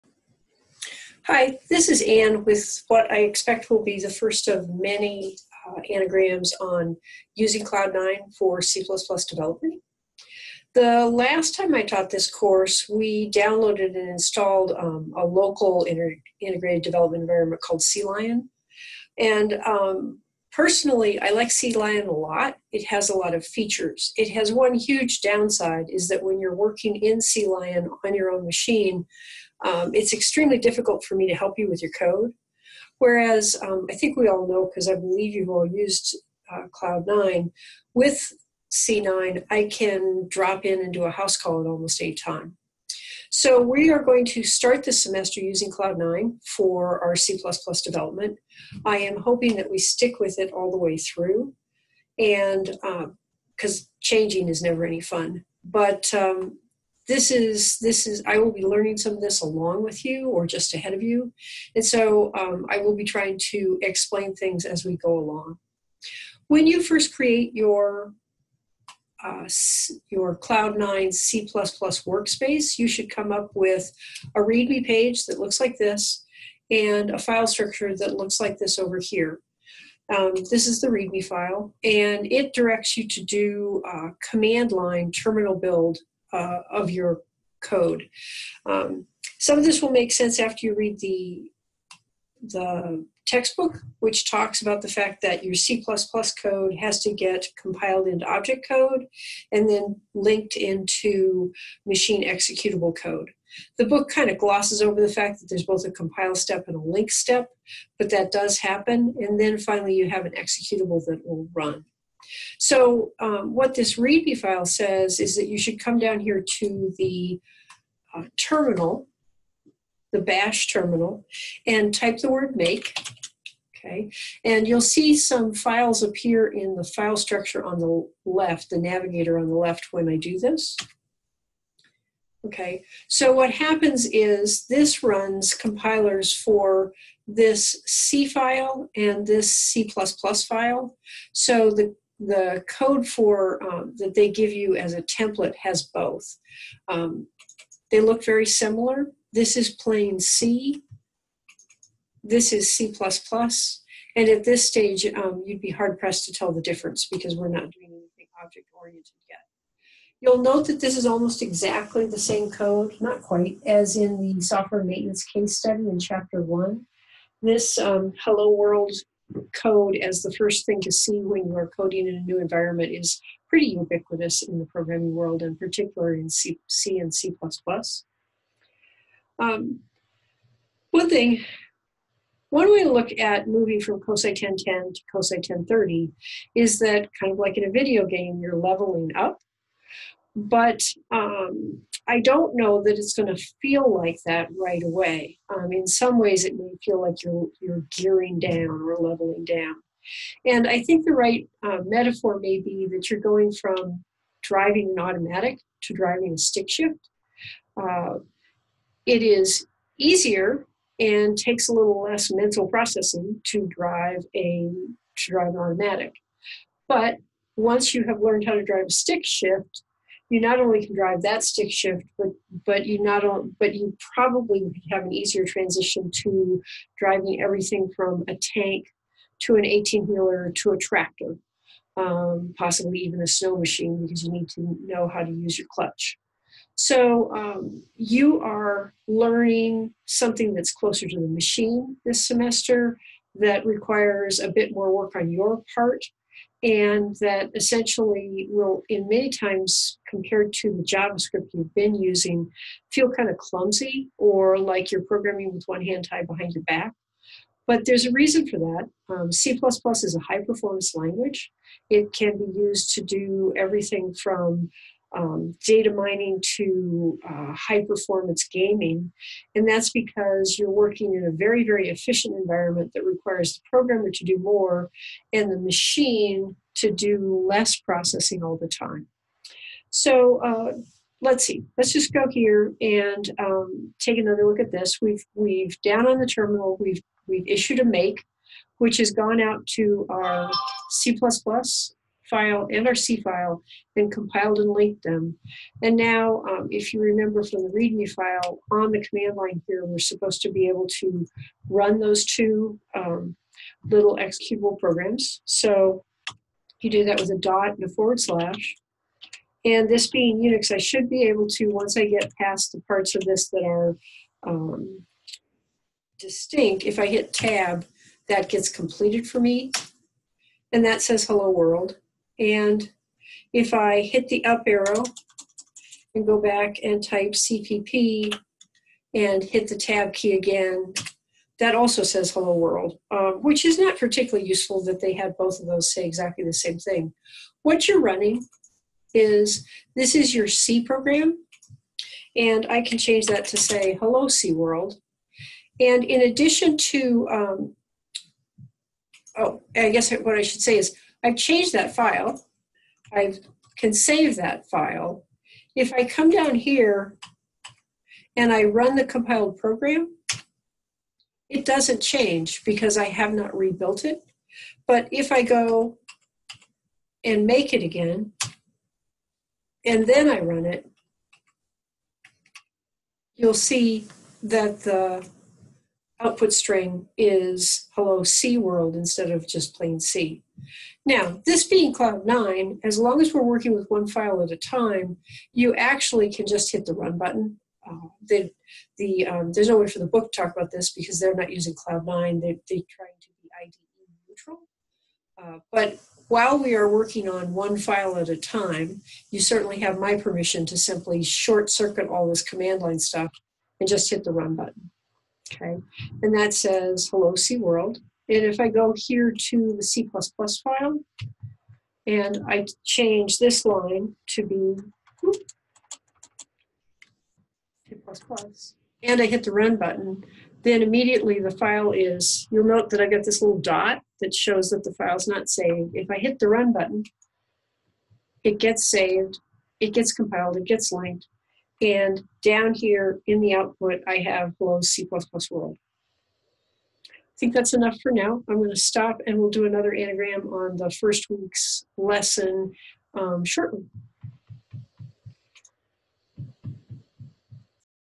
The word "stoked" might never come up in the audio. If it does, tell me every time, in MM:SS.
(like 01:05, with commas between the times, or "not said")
not said.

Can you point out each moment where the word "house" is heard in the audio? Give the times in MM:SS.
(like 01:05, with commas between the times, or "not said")
00:41.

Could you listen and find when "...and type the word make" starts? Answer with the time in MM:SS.
02:01.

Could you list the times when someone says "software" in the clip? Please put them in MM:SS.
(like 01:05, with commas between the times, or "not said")
02:44.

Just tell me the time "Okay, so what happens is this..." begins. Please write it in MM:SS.
02:12.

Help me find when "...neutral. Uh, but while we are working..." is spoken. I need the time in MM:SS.
06:34.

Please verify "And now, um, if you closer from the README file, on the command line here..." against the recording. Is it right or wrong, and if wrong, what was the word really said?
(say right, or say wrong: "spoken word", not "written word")
wrong: "remember", not "closer".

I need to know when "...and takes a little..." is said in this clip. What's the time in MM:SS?
03:30.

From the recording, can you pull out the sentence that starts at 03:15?
Um, in some ways, it may feel like you're you're gearing down or leveling down.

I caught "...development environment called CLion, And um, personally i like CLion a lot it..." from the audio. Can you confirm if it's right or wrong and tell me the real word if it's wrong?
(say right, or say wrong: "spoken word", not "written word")
right.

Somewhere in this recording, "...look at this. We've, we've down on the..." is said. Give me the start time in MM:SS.
04:44.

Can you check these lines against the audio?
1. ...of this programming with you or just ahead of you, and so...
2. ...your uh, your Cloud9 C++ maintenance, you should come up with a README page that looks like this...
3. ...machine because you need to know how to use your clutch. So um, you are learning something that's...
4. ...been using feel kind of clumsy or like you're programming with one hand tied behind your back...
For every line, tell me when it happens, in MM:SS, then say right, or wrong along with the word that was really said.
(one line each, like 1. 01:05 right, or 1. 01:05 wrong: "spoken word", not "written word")
1. 00:59 wrong: "along", not "programming"
2. 01:07 wrong: "workspace", not "maintenance"
3. 03:53 right
4. 04:11 right.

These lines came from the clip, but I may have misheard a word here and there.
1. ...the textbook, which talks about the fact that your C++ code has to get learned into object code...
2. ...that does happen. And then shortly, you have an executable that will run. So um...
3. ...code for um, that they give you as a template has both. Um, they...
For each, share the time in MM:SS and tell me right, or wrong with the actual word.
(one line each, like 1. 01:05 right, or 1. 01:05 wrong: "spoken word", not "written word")
1. 01:32 wrong: "compiled", not "learned"
2. 01:48 wrong: "finally", not "shortly"
3. 02:22 right.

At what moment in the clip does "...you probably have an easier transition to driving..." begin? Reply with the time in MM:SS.
03:43.